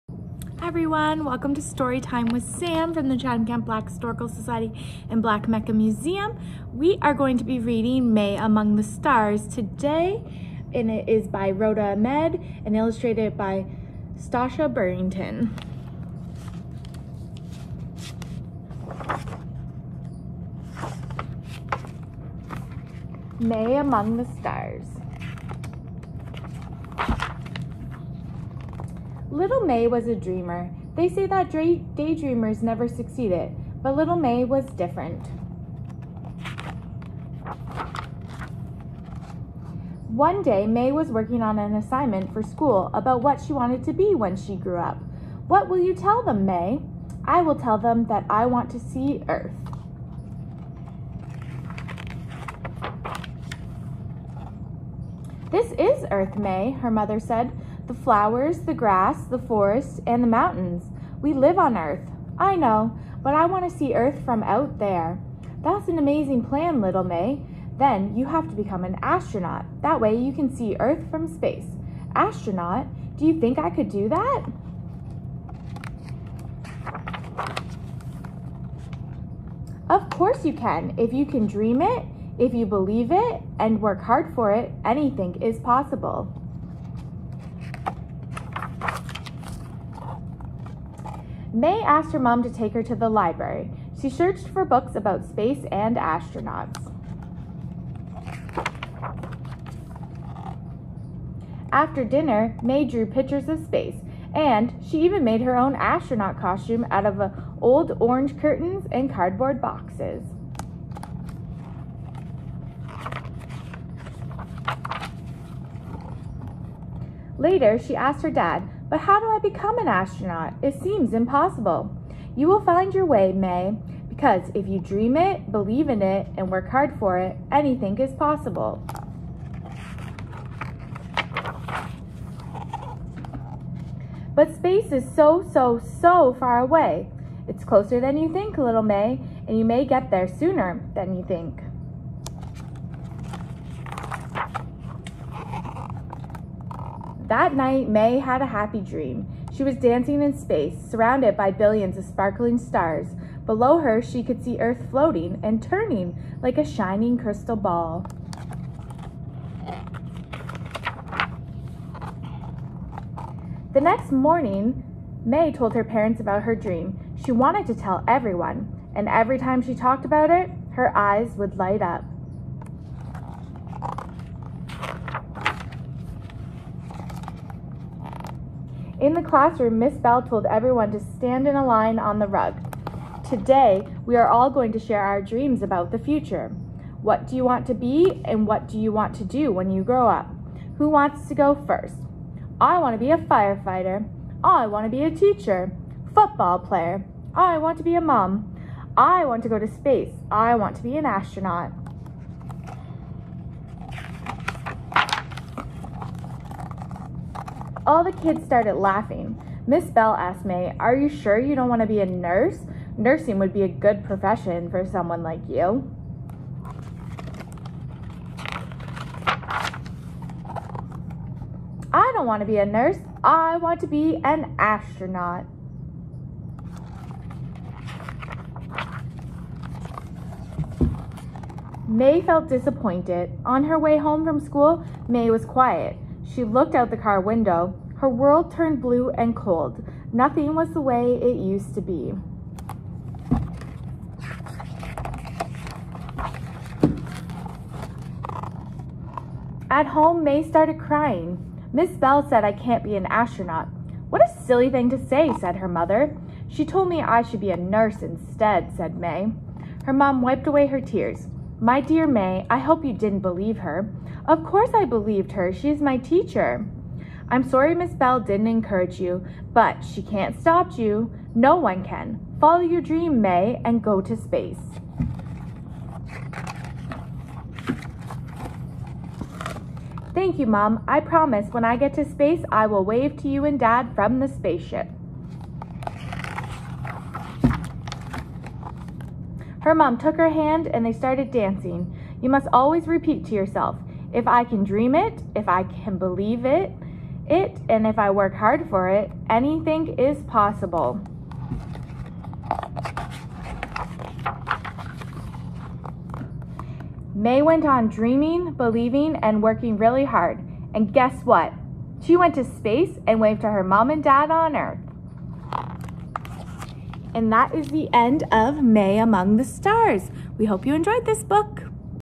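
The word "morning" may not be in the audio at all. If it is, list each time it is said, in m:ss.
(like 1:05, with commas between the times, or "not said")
2:44.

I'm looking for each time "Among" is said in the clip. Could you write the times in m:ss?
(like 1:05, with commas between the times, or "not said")
0:08, 0:23, 5:18.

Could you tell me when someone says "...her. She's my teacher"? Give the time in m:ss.
4:25.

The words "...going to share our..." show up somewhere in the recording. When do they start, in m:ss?
3:04.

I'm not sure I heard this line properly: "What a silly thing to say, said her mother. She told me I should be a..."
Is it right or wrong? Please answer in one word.
right.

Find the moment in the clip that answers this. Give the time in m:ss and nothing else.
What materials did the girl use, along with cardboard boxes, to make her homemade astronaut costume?
1:47.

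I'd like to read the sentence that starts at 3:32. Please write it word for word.
Nursing would be a good profession for someone like you.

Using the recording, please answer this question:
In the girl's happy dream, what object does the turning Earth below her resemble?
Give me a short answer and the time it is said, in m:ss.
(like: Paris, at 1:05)
a shining crystal ball, at 2:36.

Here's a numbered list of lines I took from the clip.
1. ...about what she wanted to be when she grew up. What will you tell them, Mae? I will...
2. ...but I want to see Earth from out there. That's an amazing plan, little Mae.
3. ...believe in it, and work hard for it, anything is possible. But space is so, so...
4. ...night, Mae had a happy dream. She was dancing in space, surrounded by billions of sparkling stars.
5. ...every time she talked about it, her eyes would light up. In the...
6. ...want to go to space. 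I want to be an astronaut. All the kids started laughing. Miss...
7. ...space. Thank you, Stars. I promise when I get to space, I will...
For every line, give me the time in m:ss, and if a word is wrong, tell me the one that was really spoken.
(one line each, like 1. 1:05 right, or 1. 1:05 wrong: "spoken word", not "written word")
1. 0:42 right
2. 1:03 right
3. 2:05 right
4. 2:27 right
5. 2:49 right
6. 3:19 right
7. 4:34 wrong: "Mom", not "Stars".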